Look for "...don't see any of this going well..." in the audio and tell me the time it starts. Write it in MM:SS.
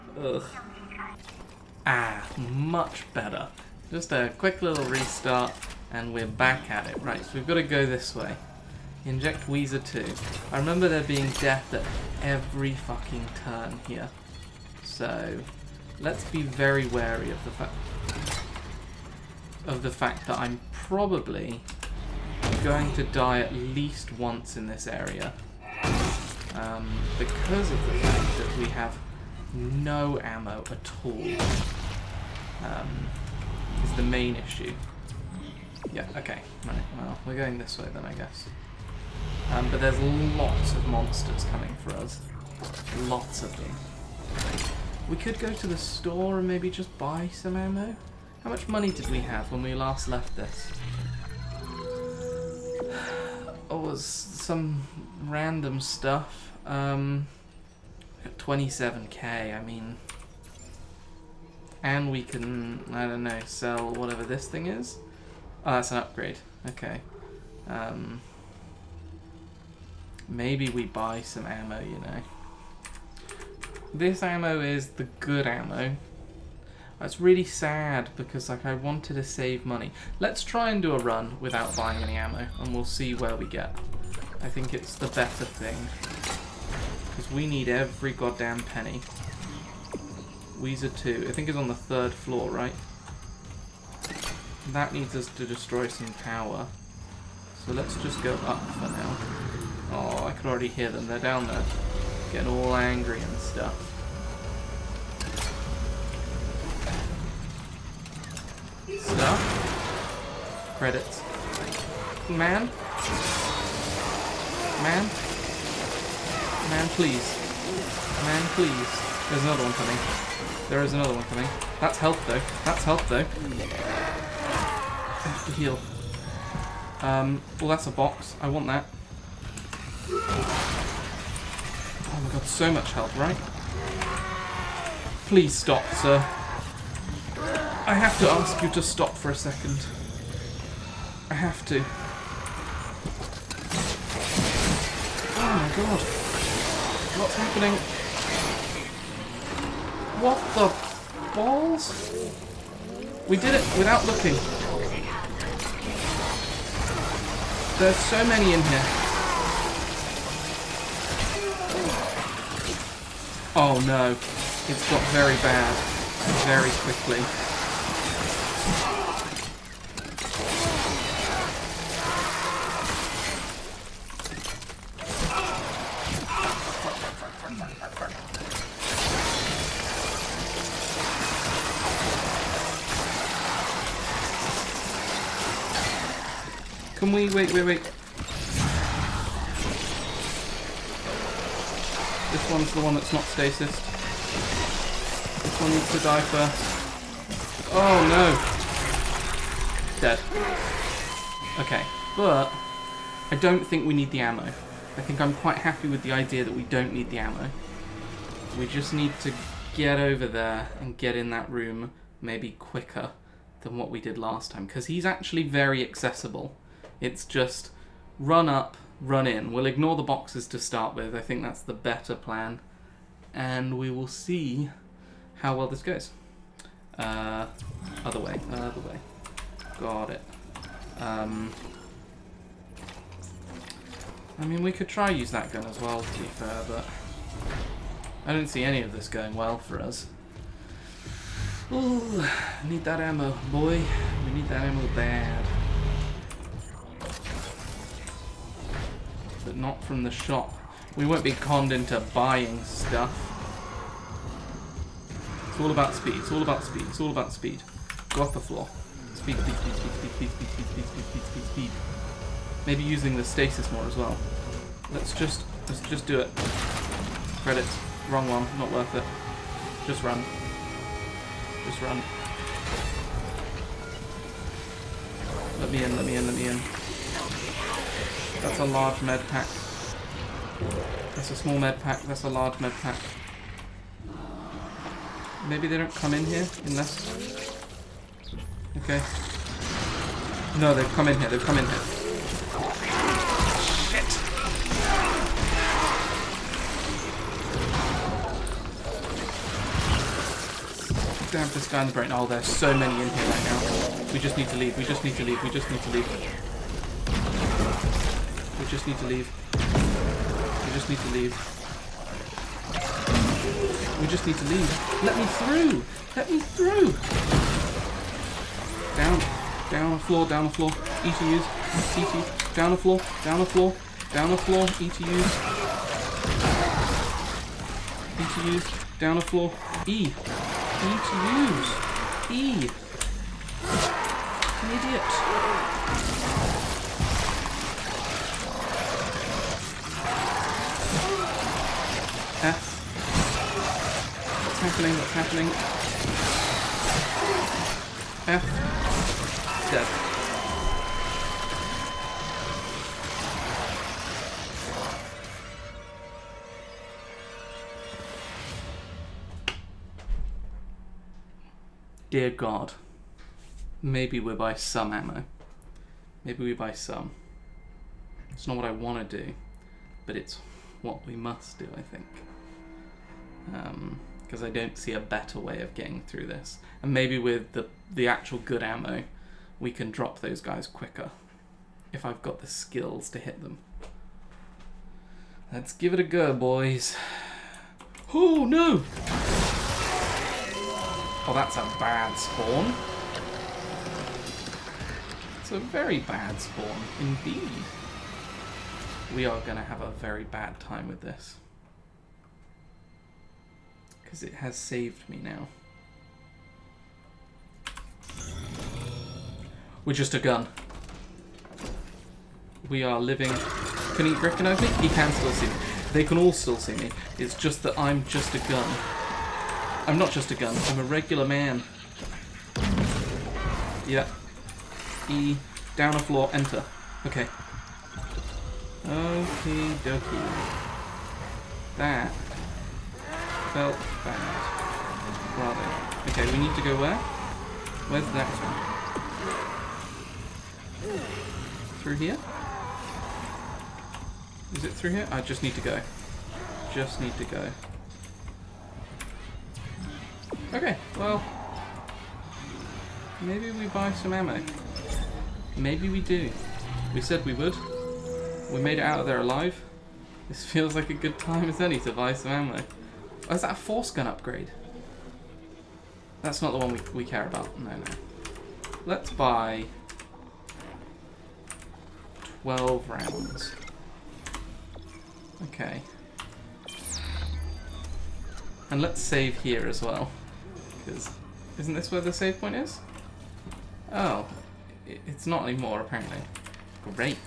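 03:58.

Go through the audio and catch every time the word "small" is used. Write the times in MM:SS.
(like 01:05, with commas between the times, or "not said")
04:41.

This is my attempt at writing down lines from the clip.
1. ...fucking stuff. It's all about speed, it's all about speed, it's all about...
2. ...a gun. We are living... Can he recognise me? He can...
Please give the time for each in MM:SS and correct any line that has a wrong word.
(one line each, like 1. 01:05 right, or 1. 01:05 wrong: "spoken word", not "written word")
1. 04:12 wrong: "buying", not "fucking"
2. 06:50 right.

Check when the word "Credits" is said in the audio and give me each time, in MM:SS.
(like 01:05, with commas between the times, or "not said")
01:50, 04:27.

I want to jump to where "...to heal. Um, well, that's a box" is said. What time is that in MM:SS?
02:05.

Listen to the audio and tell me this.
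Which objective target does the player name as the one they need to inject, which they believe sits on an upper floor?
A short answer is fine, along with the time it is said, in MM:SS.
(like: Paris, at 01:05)
Wheezer 2, at 00:09.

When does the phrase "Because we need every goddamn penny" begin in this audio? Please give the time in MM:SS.
01:27.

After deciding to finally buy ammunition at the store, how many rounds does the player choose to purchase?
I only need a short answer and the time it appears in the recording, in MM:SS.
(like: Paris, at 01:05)
12, at 07:52.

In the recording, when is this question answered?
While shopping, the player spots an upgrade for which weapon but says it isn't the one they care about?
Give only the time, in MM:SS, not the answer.
07:43.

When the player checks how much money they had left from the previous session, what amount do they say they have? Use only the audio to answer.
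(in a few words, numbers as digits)
27k.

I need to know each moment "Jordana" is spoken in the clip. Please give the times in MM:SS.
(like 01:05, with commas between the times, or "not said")
not said.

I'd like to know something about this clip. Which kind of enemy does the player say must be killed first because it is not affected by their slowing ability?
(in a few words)
the one that's not stasis.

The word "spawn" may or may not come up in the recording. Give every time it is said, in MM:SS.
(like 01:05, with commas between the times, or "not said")
06:32, 06:36.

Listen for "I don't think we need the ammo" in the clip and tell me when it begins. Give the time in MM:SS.
03:23.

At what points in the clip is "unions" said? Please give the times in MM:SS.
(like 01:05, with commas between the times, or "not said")
not said.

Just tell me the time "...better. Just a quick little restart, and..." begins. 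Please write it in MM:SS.
00:03.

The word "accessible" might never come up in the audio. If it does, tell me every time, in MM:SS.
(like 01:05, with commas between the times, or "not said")
03:35.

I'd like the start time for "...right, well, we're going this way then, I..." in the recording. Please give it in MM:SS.
00:36.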